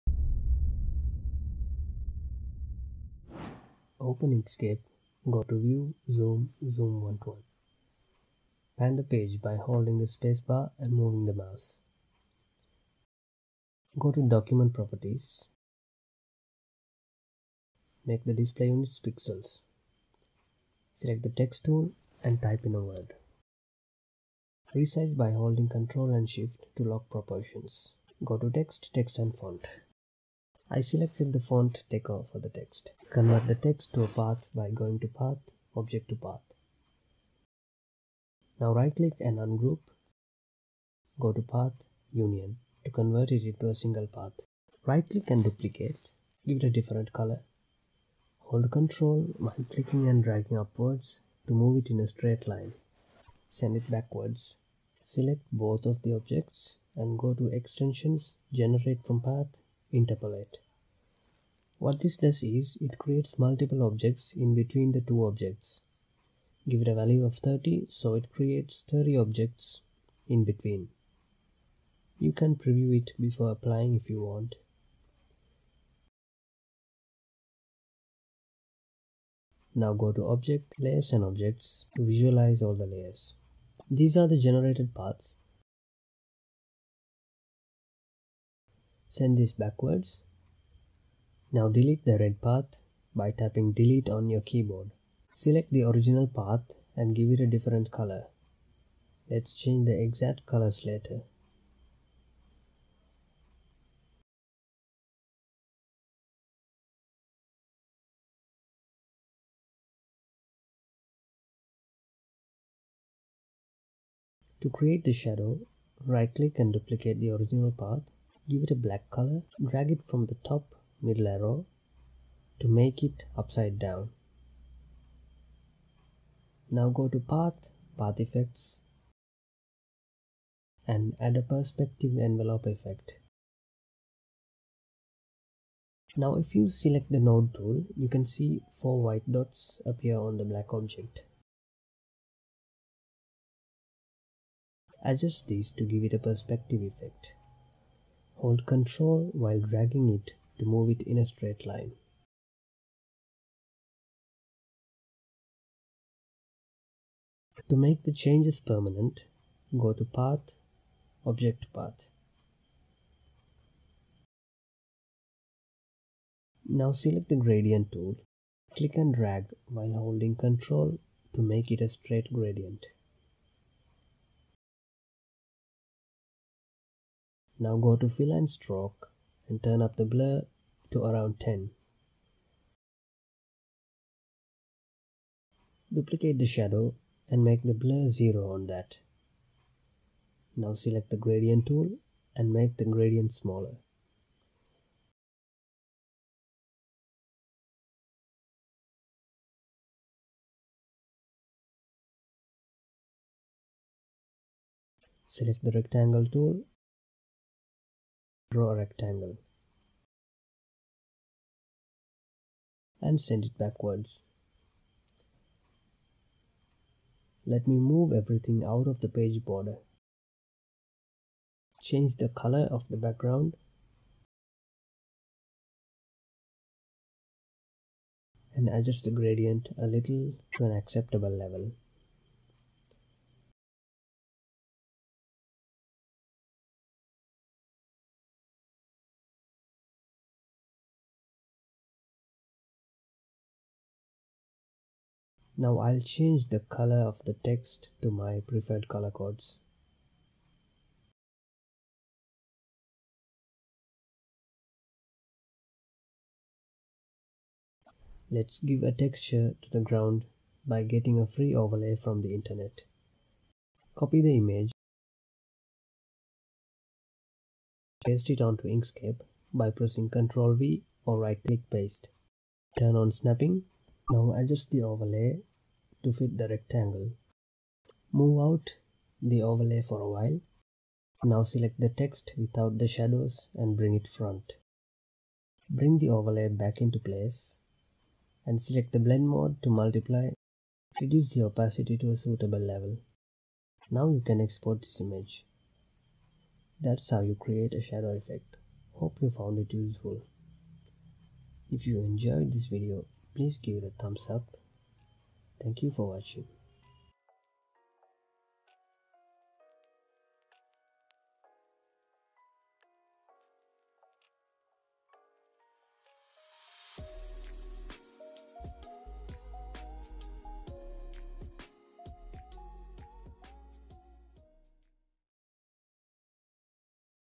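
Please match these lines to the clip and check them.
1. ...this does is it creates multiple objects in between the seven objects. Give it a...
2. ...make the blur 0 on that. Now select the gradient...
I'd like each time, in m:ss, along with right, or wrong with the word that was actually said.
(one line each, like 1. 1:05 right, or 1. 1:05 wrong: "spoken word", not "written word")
1. 1:02 wrong: "two", not "seven"
2. 3:07 right.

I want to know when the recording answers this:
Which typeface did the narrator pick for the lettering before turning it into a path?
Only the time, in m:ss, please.
0:31.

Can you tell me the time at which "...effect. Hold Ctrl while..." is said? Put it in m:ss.
2:26.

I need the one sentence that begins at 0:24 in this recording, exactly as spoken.
Resize by holding Ctrl and Shift to lock proportions.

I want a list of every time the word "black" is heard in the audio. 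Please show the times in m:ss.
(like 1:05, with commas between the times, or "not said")
1:58, 2:20.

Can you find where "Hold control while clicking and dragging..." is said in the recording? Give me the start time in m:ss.
0:48.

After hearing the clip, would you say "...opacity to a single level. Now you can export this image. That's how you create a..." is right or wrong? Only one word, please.
wrong.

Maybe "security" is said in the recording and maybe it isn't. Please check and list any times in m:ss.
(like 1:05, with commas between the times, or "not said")
not said.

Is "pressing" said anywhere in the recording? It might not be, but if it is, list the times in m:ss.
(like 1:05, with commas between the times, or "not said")
4:29.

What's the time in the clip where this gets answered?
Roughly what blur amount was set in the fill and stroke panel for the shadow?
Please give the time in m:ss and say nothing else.
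3:01.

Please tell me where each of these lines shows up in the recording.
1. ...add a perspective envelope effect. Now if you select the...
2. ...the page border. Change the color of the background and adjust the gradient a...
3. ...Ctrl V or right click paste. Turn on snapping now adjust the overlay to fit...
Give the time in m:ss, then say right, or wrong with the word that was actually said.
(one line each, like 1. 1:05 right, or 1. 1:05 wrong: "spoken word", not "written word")
1. 2:11 right
2. 3:38 right
3. 4:30 right.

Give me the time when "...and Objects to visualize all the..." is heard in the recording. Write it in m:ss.
1:21.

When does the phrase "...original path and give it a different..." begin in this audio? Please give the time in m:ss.
1:35.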